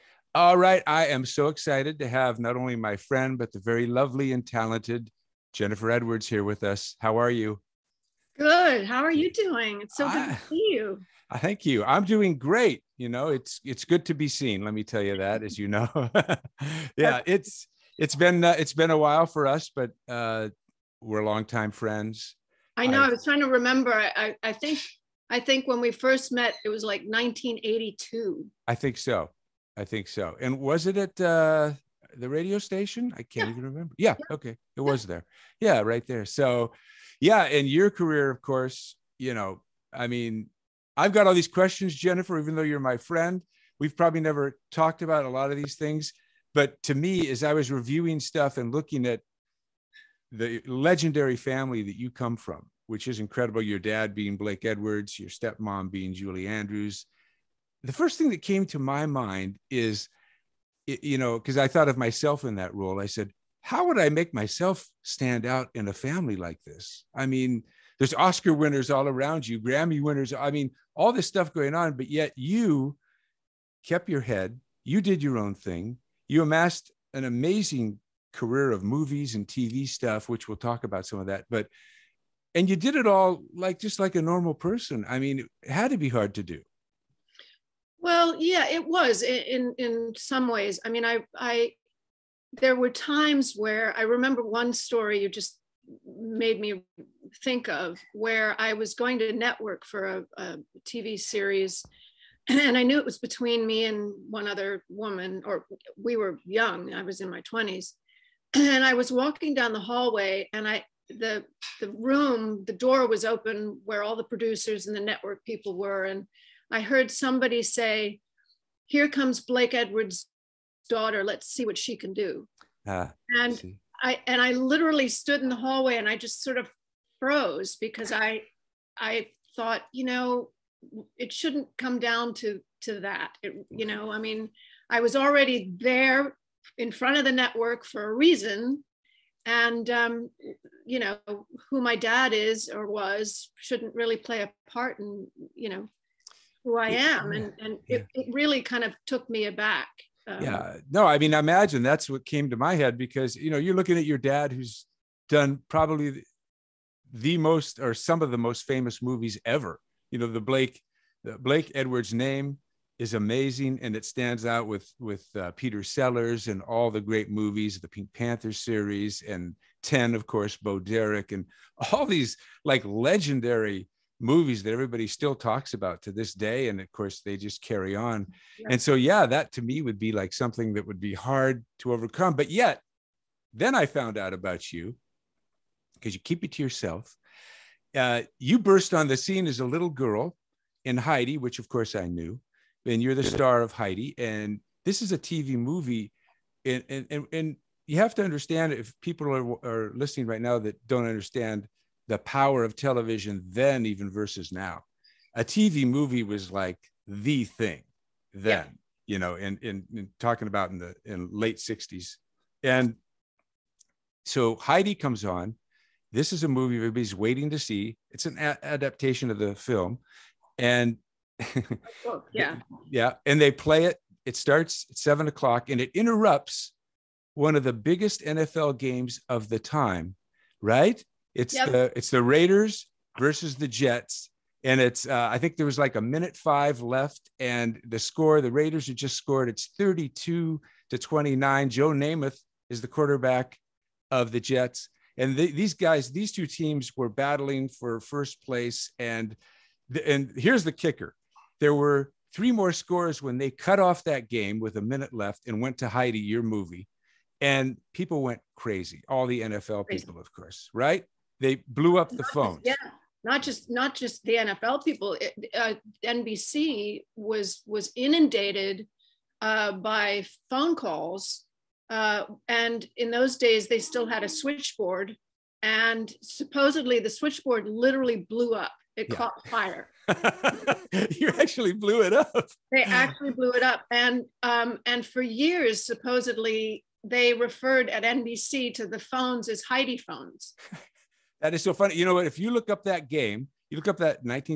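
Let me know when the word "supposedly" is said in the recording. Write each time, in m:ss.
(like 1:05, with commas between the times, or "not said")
4:36, 4:45.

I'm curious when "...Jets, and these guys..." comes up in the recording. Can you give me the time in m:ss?
4:04.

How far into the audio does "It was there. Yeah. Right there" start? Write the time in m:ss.
0:34.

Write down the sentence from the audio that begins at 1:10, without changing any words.
I mean, all this stuff going on, but yet you kept your head.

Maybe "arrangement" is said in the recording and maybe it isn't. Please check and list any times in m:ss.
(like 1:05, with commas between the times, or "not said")
not said.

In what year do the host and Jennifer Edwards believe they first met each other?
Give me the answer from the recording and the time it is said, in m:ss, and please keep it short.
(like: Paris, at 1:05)
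1982, at 0:27.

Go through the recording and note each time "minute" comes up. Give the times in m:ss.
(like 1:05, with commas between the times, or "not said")
3:56, 4:14.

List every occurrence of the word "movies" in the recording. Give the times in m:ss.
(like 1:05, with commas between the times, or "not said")
1:18, 2:39, 2:47, 2:54, 3:15, 3:25, 3:36, 4:16.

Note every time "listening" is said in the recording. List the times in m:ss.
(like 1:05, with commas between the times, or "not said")
3:19.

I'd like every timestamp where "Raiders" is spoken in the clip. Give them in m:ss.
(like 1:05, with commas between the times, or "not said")
3:52, 3:58.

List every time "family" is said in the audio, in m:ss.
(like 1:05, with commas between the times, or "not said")
0:51, 1:05.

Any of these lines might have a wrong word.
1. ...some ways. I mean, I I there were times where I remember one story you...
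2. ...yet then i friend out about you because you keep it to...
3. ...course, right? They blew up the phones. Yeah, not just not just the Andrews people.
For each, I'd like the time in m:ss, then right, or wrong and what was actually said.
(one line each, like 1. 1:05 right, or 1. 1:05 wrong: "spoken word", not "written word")
1. 1:30 right
2. 3:02 wrong: "found", not "friend"
3. 4:20 wrong: "NFL", not "Andrews".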